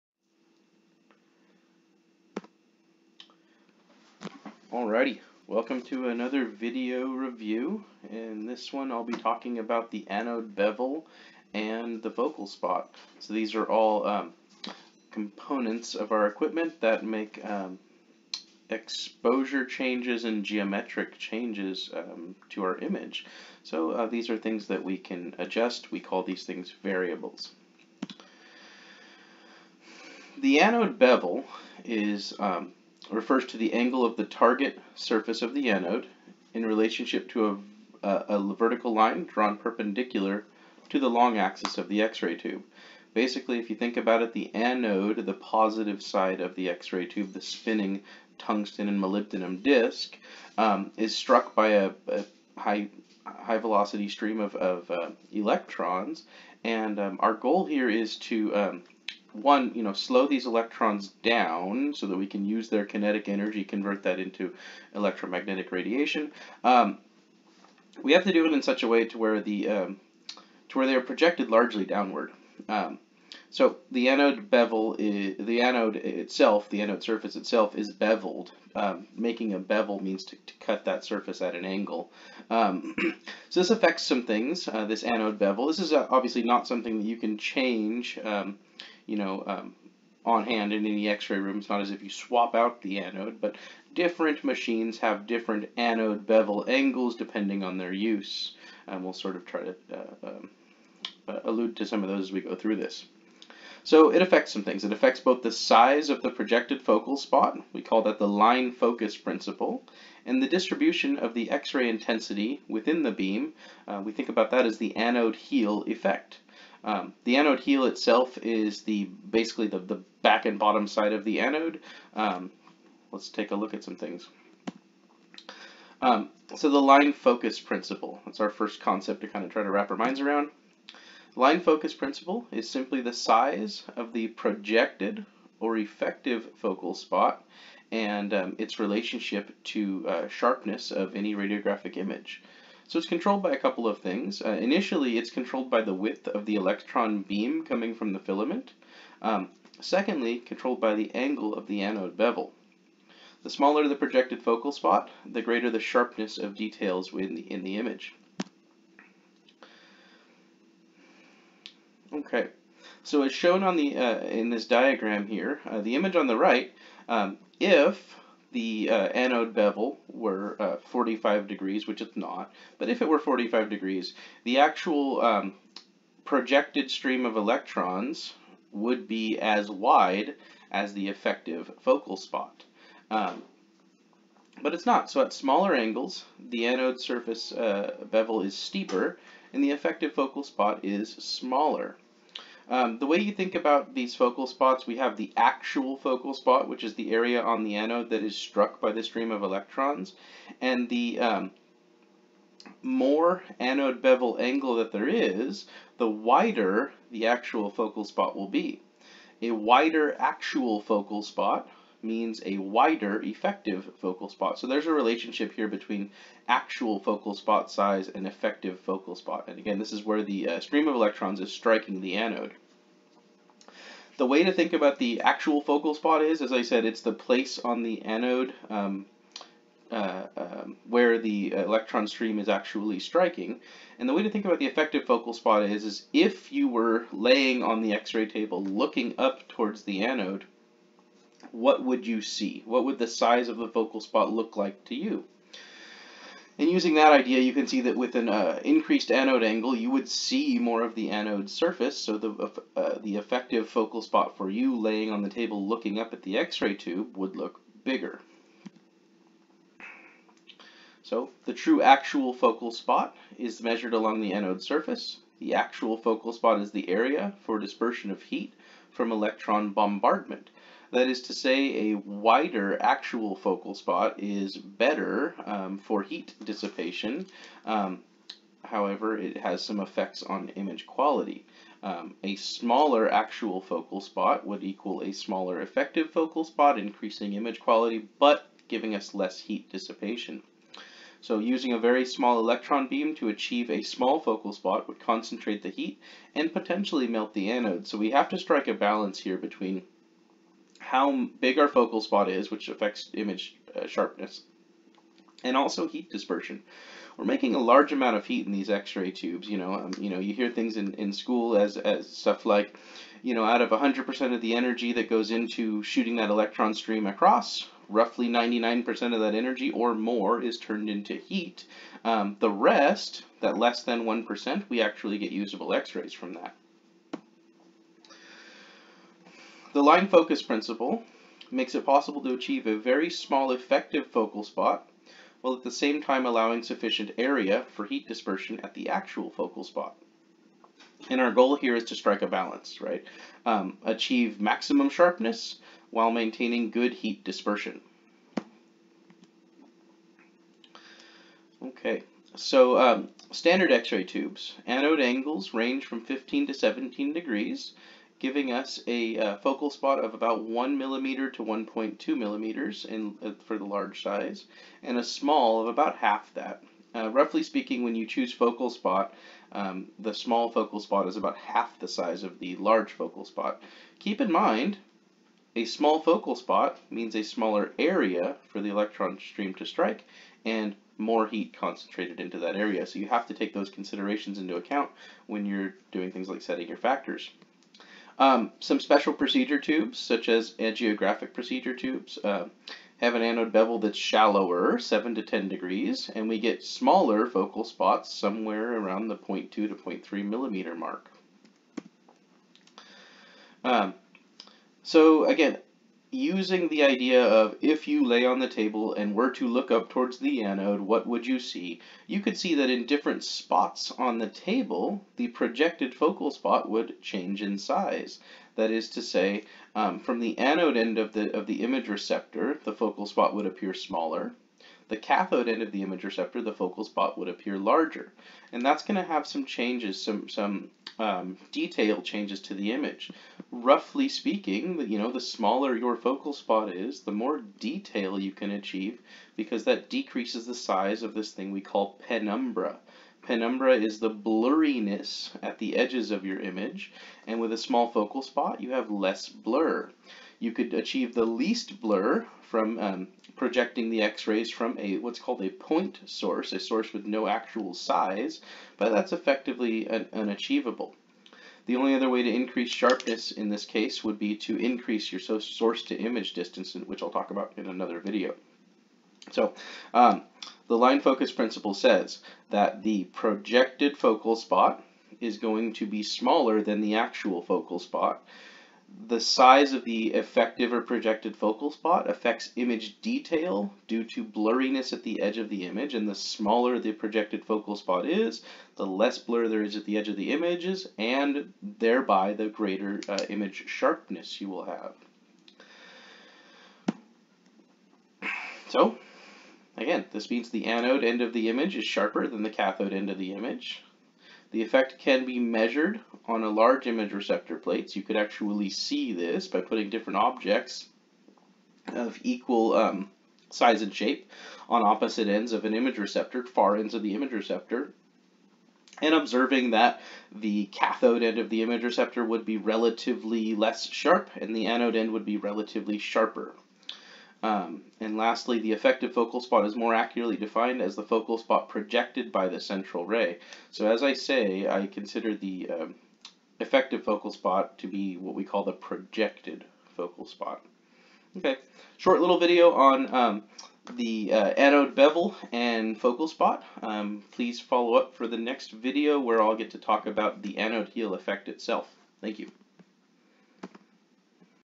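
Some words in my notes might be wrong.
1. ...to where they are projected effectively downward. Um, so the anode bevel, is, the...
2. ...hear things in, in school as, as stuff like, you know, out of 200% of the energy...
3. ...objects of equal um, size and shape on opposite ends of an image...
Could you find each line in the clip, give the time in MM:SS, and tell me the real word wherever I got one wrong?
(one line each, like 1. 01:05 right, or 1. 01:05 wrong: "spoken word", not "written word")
1. 01:10 wrong: "largely", not "effectively"
2. 05:10 wrong: "100", not "200"
3. 08:30 right.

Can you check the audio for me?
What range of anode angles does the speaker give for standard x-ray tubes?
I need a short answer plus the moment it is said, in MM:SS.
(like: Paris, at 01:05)
15 to 17 degrees, at 05:56.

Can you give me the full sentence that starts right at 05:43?
Um, achieve maximum sharpness while maintaining good heat dispersion.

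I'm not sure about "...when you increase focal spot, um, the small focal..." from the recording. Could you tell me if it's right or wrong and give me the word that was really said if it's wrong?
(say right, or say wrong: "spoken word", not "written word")
wrong: "choose", not "increase".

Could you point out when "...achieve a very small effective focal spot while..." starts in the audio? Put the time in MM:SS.
05:32.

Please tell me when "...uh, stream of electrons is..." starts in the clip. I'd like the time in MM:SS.
03:40.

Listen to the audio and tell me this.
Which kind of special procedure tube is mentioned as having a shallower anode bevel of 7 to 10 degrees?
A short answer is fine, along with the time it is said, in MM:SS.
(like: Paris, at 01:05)
angiographic, at 06:30.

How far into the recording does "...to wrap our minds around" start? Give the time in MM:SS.
02:09.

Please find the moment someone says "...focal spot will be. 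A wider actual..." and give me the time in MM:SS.
03:27.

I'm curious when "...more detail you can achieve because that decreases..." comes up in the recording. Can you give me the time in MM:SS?
07:17.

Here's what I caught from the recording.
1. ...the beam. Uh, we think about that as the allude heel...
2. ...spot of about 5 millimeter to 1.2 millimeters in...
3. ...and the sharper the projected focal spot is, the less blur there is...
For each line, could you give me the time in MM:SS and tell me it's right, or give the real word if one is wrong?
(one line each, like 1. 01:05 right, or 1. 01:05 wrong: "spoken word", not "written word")
1. 01:53 wrong: "anode", not "allude"
2. 05:59 wrong: "1", not "5"
3. 08:05 wrong: "smaller", not "sharper".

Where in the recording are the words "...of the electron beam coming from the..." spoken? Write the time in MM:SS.
02:26.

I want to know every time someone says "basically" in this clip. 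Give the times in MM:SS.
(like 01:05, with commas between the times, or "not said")
00:43, 01:59.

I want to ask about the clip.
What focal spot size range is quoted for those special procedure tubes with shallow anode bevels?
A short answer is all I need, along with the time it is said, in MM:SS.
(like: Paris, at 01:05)
0.2 to 0.3 mm, at 06:39.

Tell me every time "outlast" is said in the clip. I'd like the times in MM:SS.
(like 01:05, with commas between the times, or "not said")
not said.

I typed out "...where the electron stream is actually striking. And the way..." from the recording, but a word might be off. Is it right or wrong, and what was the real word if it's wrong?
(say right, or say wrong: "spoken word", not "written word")
right.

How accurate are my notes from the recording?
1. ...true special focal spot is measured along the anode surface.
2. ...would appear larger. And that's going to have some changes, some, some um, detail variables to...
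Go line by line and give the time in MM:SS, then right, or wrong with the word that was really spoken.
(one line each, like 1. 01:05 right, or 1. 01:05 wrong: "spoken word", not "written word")
1. 04:21 wrong: "actual", not "special"
2. 07:07 wrong: "changes", not "variables".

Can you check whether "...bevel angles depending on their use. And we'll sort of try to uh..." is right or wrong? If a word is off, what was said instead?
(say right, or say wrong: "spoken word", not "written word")
right.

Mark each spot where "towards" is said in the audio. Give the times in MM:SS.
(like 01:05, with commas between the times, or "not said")
03:59, 06:49.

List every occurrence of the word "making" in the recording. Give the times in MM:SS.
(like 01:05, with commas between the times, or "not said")
01:19, 05:07.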